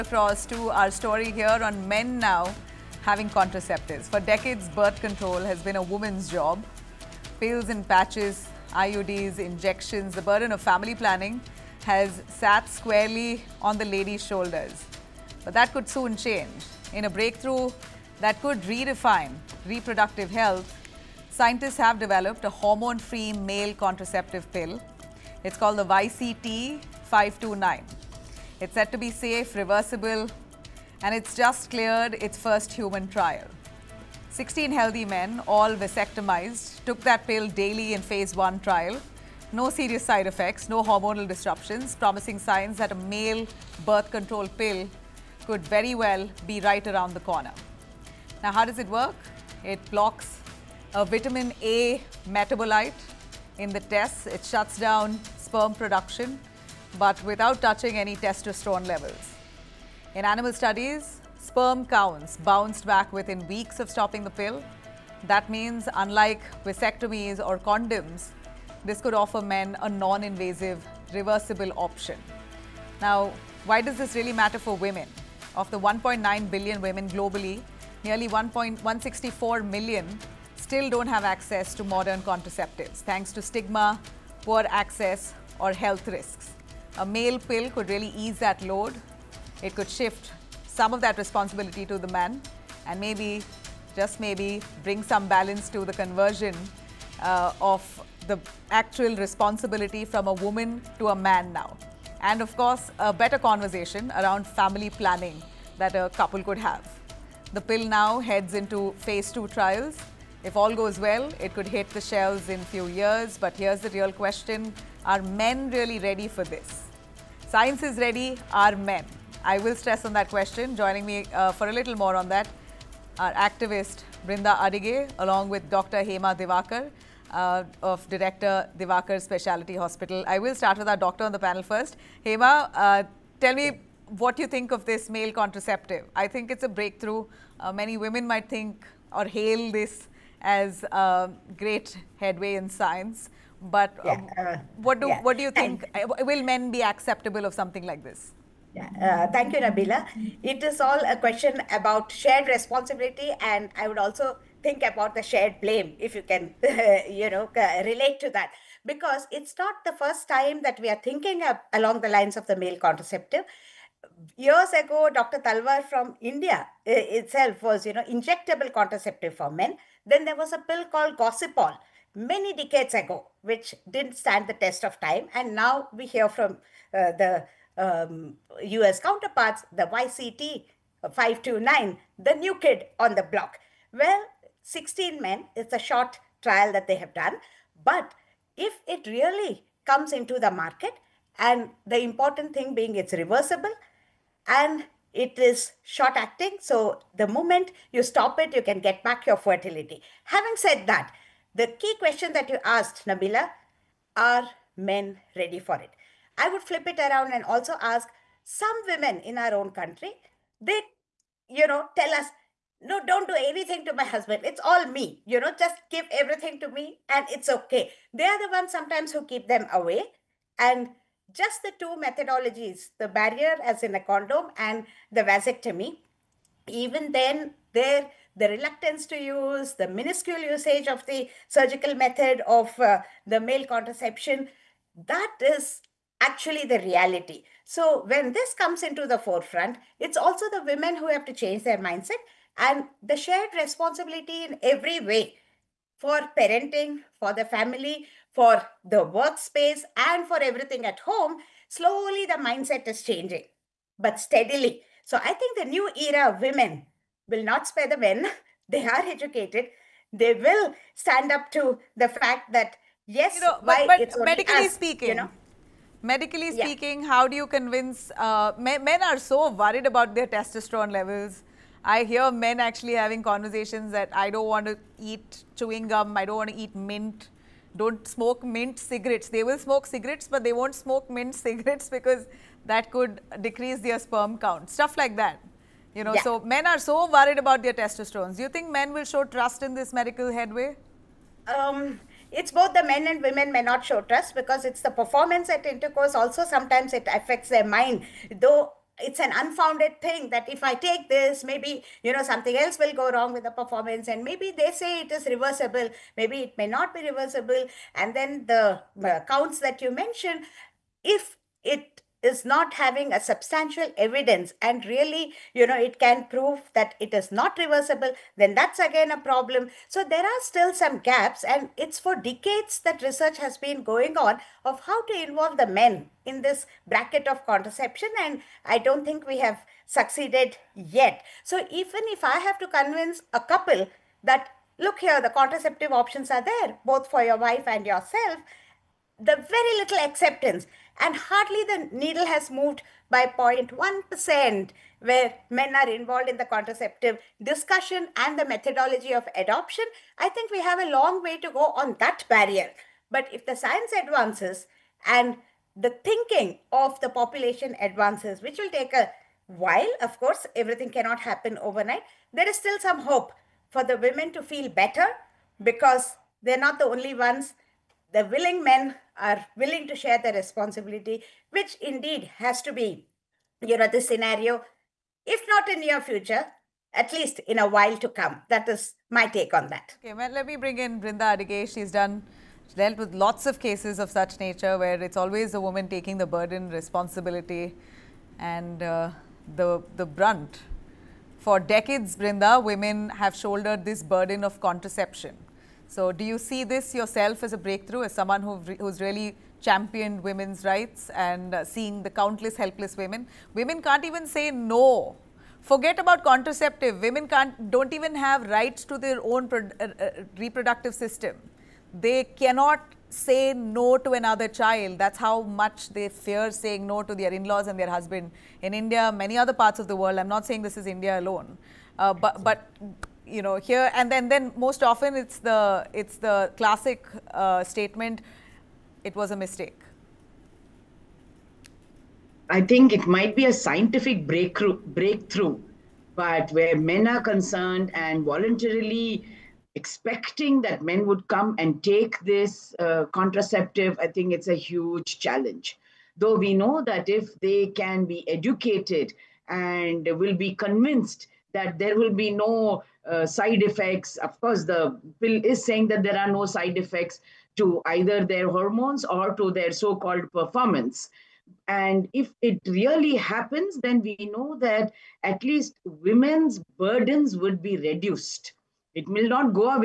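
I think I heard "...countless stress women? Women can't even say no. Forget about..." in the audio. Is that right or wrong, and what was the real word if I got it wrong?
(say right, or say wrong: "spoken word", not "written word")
wrong: "helpless", not "stress".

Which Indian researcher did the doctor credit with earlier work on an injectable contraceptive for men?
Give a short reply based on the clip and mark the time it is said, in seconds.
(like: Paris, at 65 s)
Dr Talwar, at 165 s.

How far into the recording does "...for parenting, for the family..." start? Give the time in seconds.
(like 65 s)
245 s.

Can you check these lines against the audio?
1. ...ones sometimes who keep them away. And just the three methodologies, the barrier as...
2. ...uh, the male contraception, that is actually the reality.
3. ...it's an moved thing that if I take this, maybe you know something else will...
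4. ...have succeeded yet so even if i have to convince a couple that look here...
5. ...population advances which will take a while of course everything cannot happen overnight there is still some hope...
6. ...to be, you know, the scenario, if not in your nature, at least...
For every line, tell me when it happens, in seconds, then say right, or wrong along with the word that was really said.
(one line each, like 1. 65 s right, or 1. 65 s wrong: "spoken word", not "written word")
1. 218 s wrong: "two", not "three"
2. 232 s right
3. 298 s wrong: "unfounded", not "moved"
4. 329 s right
5. 357 s right
6. 372 s wrong: "future", not "nature".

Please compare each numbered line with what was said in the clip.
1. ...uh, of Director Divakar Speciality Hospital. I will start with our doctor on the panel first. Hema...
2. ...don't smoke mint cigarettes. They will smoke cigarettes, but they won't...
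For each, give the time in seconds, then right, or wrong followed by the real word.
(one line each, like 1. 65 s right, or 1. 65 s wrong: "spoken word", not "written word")
1. 127 s right
2. 277 s right.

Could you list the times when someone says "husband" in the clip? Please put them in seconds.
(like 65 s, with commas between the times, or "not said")
214 s, 417 s.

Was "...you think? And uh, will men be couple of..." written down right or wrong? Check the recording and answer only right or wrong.
wrong.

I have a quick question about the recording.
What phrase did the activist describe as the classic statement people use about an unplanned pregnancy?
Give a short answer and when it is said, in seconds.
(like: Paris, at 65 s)
it was a mistake, at 429 s.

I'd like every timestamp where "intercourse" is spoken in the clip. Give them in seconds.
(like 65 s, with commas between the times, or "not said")
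295 s.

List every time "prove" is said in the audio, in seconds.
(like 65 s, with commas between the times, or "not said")
316 s.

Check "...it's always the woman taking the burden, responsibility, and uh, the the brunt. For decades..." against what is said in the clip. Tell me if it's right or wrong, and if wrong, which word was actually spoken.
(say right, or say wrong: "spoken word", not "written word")
right.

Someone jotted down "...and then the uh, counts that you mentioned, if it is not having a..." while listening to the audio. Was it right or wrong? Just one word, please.
right.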